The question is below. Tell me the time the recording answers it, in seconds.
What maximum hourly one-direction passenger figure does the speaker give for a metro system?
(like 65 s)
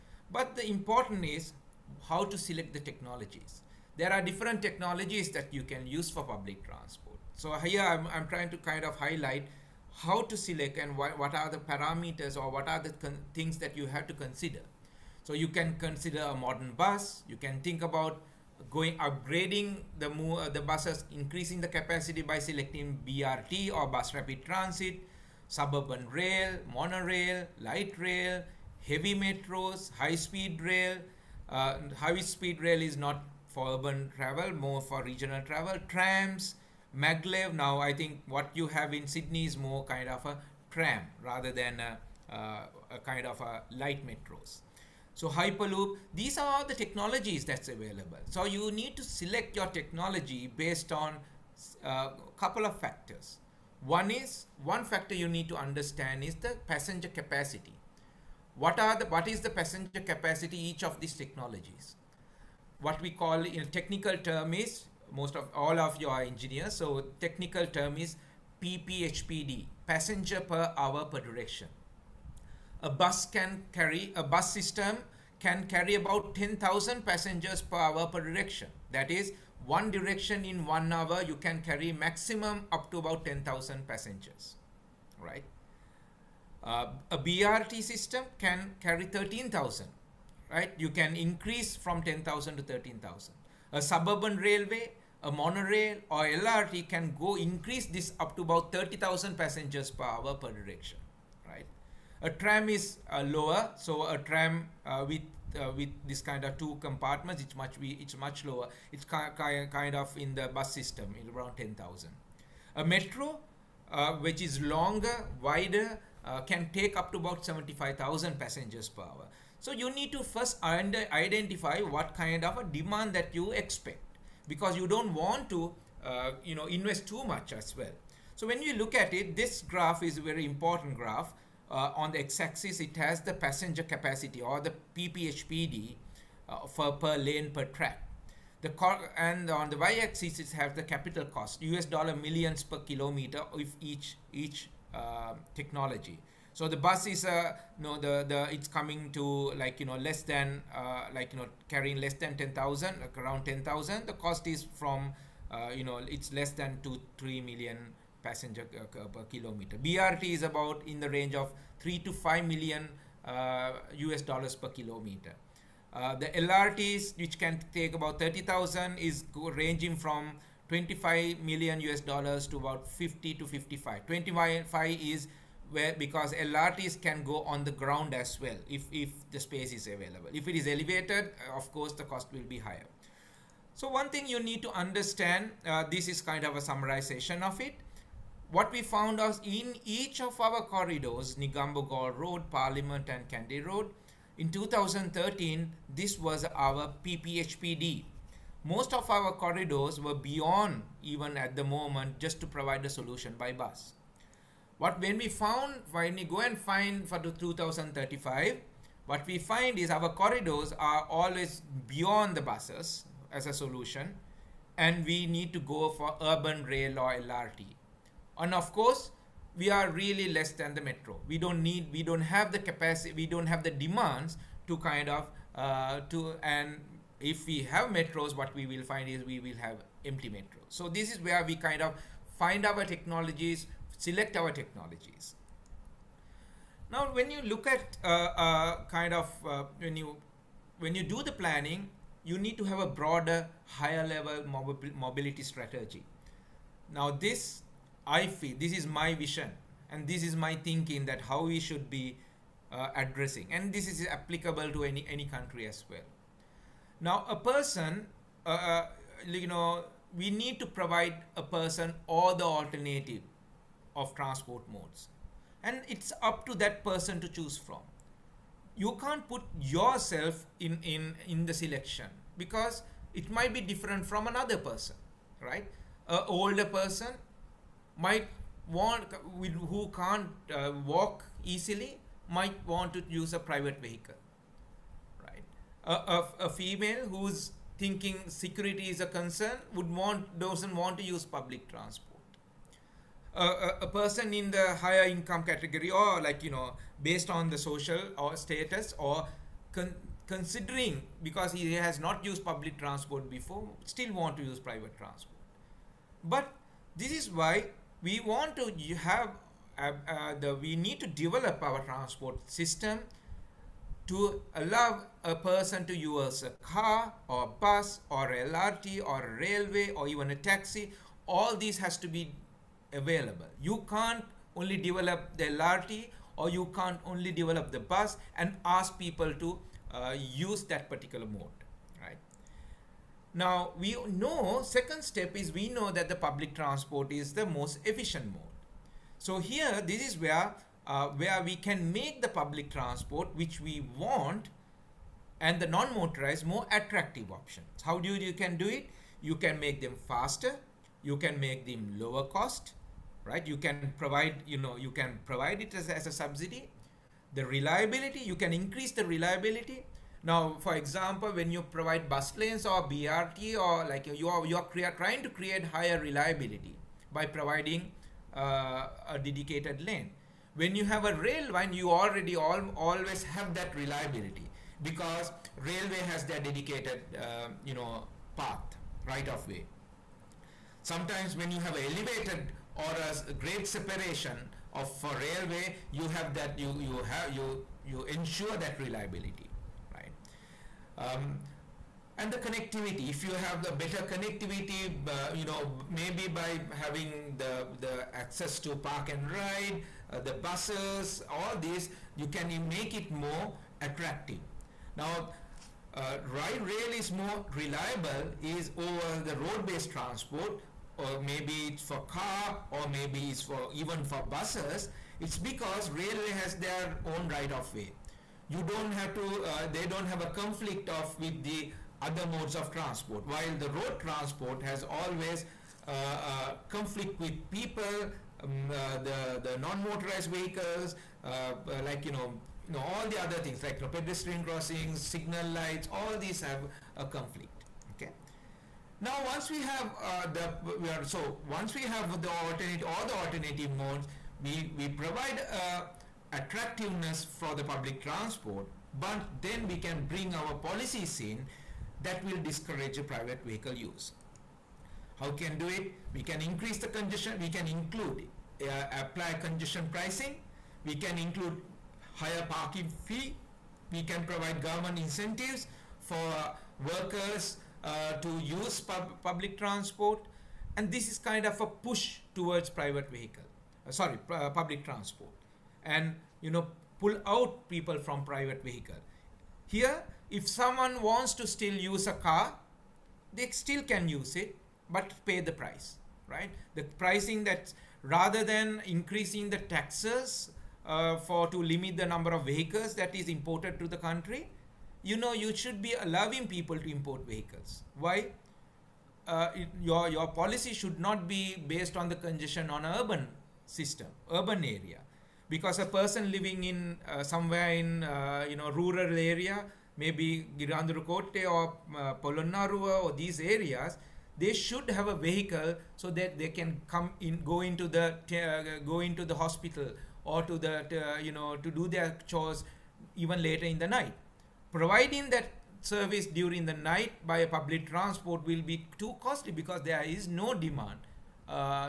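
117 s.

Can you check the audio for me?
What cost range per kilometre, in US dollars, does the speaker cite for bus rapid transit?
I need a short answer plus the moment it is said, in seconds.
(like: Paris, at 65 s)
3 to 5 million, at 161 s.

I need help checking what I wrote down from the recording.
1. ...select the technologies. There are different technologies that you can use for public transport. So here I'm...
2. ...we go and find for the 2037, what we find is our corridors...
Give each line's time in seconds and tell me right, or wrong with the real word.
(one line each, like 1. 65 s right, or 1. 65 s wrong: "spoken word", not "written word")
1. 2 s right
2. 206 s wrong: "2035", not "2037".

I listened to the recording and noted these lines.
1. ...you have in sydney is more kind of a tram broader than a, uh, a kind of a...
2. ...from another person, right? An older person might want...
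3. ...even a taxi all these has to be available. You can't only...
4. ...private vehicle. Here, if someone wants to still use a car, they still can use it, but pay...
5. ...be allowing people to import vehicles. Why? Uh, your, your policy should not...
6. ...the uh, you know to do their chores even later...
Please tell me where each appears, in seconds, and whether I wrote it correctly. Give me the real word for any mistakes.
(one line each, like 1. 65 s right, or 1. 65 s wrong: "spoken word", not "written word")
1. 38 s wrong: "rather", not "broader"
2. 274 s right
3. 320 s right
4. 478 s right
5. 495 s right
6. 520 s right.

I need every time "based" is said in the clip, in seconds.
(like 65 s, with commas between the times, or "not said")
50 s, 297 s, 409 s, 501 s.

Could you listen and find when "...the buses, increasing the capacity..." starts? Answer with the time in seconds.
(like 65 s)
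20 s.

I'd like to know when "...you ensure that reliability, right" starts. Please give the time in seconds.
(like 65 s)
387 s.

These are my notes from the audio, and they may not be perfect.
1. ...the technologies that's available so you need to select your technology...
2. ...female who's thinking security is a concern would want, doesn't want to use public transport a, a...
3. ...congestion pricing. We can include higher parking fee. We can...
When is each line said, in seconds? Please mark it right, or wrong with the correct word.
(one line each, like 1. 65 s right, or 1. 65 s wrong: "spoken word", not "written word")
1. 46 s right
2. 286 s right
3. 459 s right.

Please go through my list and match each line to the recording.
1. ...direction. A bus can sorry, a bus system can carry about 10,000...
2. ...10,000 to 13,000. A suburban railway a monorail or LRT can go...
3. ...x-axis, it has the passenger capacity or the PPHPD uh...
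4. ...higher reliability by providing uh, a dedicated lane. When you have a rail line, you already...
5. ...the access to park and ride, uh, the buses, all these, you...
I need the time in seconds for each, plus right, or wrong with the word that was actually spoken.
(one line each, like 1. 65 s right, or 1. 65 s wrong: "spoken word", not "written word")
1. 71 s wrong: "carry", not "sorry"
2. 92 s right
3. 132 s right
4. 365 s right
5. 397 s right.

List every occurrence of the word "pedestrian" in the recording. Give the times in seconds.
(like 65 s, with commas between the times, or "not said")
433 s.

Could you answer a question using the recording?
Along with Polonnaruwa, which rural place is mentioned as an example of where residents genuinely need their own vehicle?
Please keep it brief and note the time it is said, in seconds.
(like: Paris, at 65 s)
Girandurukotte, at 510 s.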